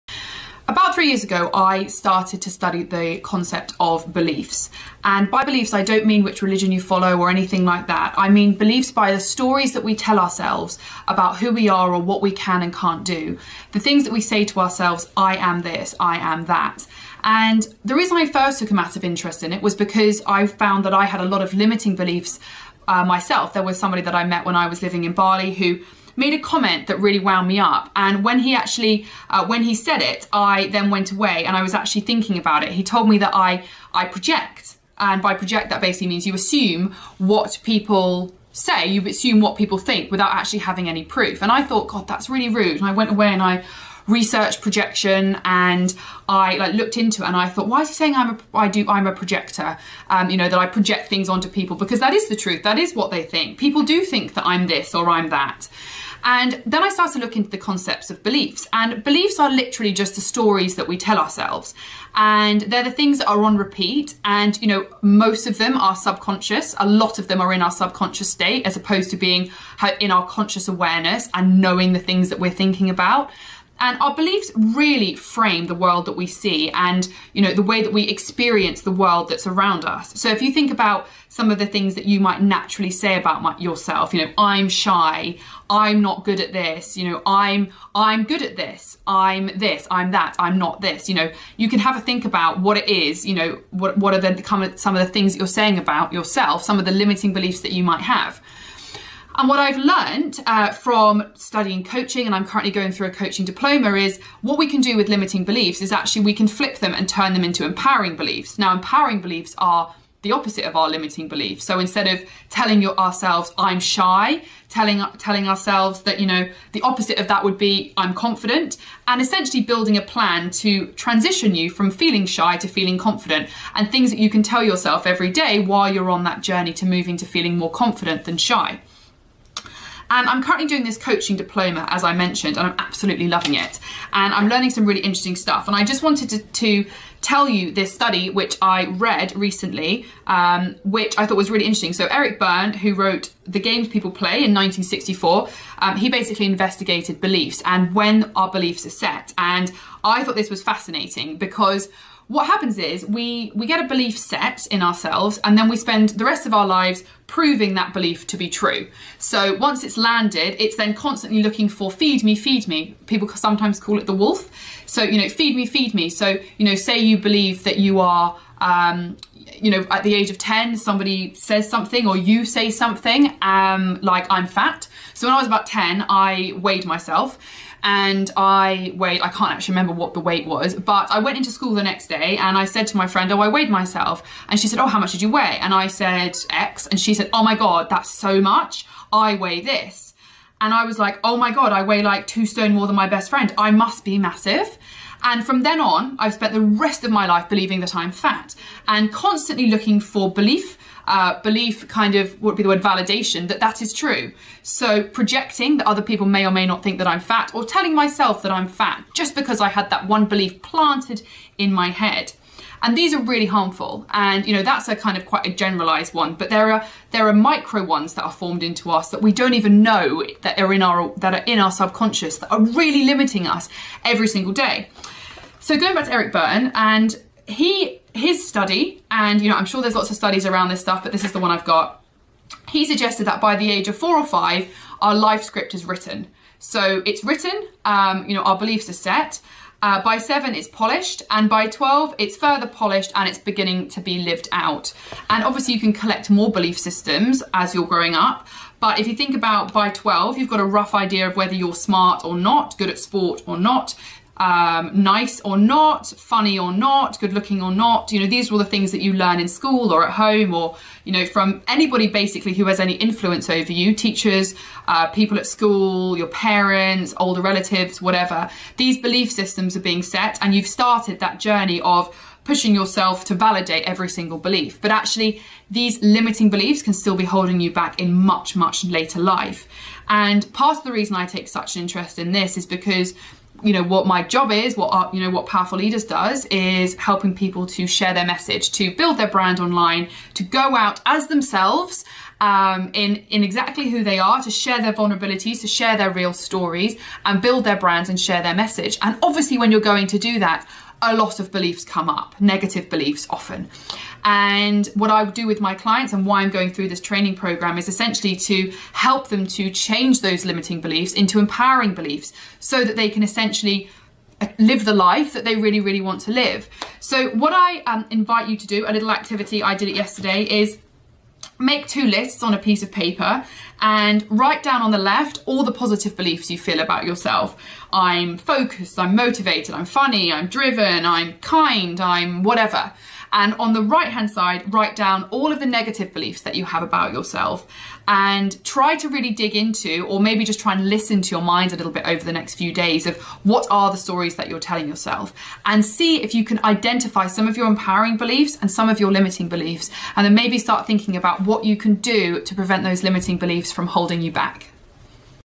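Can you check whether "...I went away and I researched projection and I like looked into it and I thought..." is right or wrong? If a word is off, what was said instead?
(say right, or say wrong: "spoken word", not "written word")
right.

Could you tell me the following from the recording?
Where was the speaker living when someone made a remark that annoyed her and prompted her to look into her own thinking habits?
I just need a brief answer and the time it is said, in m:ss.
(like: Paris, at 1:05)
Bali, at 0:25.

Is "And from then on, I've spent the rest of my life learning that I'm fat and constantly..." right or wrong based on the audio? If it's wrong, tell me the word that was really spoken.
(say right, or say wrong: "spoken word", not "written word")
wrong: "believing", not "learning".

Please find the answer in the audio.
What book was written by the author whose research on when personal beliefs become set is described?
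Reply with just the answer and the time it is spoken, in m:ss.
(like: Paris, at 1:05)
The Games People Play, at 2:23.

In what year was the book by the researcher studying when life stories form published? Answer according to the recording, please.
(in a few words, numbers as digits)
1964.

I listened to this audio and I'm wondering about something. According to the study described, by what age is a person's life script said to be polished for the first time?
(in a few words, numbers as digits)
7.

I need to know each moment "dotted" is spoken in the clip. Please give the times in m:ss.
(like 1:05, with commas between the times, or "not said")
not said.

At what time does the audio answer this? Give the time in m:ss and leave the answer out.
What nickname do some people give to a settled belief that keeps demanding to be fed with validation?
2:44.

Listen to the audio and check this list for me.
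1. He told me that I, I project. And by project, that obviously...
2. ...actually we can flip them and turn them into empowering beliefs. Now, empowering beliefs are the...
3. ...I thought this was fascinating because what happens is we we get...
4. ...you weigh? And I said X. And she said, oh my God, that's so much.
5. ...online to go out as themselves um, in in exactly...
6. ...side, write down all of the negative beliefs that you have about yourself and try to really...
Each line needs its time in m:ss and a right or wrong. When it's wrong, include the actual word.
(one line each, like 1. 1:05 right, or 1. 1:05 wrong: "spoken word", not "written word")
1. 0:32 wrong: "basically", not "obviously"
2. 1:45 right
3. 2:30 right
4. 3:05 right
5. 4:49 right
6. 5:34 right.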